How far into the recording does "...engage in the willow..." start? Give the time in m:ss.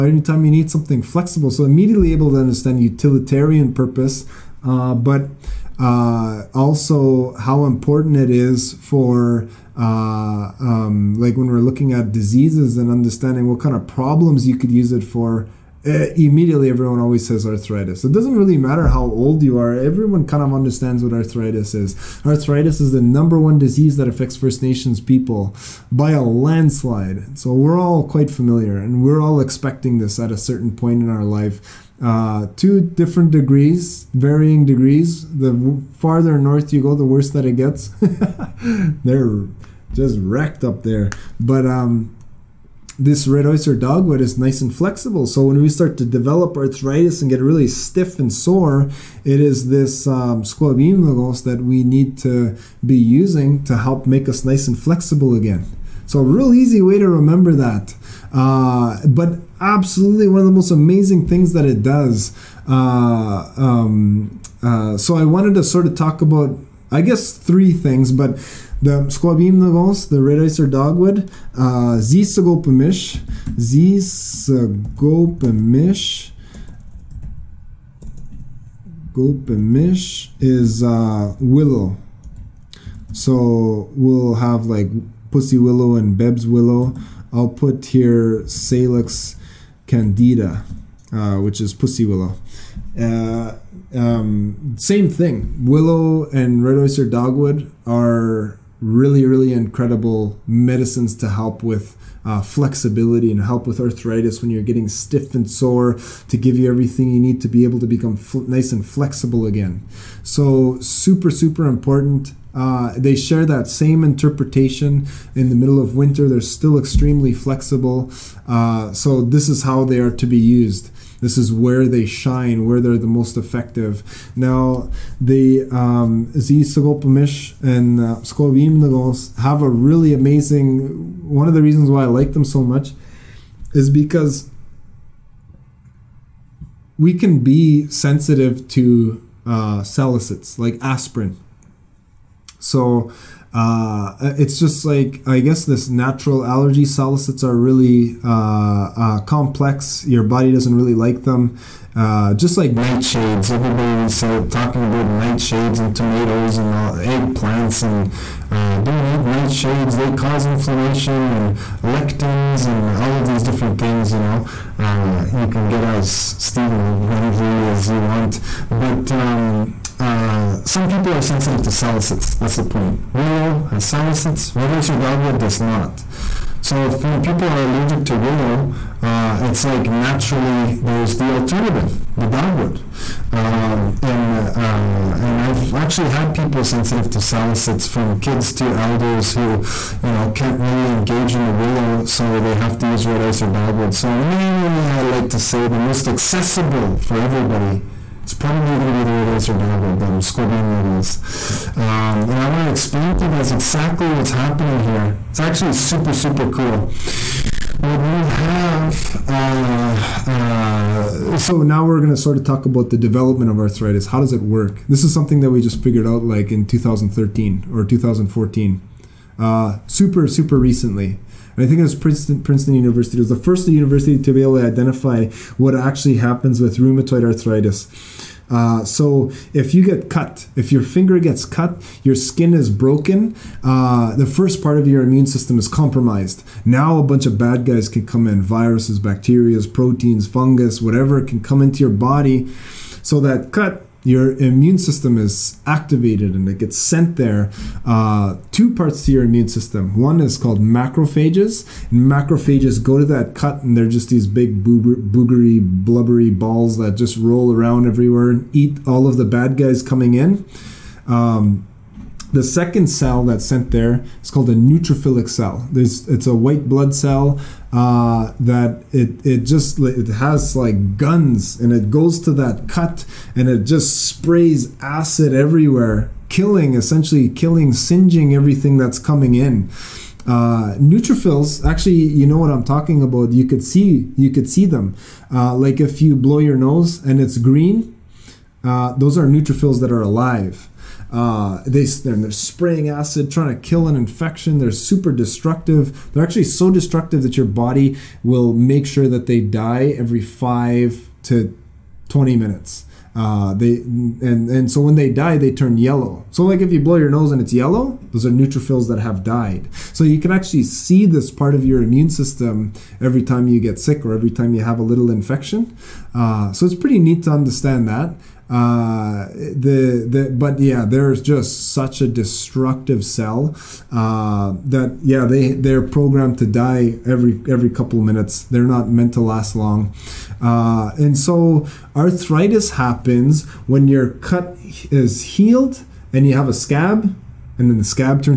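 3:10.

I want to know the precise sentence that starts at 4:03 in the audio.
So that cut your immune system is activated and it gets sent there.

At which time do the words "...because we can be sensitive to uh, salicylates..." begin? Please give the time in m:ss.
2:13.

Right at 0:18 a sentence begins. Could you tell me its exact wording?
It doesn't really matter how old you are, everyone kind of understands what arthritis is.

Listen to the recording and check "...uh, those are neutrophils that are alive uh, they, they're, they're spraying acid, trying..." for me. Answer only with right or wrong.
right.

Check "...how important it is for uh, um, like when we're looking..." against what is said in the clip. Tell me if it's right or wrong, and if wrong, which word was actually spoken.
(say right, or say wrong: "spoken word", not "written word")
right.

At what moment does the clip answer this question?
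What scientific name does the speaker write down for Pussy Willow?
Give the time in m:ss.
1:28.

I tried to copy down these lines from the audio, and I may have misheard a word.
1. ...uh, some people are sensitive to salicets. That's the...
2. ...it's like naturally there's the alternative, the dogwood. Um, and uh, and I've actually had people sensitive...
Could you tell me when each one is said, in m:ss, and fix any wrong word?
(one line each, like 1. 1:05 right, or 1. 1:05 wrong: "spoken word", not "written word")
1. 2:49 right
2. 2:59 right.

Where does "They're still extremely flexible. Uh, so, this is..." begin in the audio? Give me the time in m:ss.
1:56.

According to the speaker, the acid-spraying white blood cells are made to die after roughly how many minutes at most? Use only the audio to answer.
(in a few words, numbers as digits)
20 minutes.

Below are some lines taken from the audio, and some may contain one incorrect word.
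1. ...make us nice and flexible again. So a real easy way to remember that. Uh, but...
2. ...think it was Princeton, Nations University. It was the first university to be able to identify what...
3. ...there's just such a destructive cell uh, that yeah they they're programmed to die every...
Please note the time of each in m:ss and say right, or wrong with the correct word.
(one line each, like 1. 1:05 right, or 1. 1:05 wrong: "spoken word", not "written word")
1. 0:54 right
2. 3:41 wrong: "Princeton", not "Nations"
3. 5:20 right.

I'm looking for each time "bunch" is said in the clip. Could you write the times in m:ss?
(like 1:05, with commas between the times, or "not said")
3:57.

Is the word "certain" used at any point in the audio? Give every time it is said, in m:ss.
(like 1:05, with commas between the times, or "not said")
0:30.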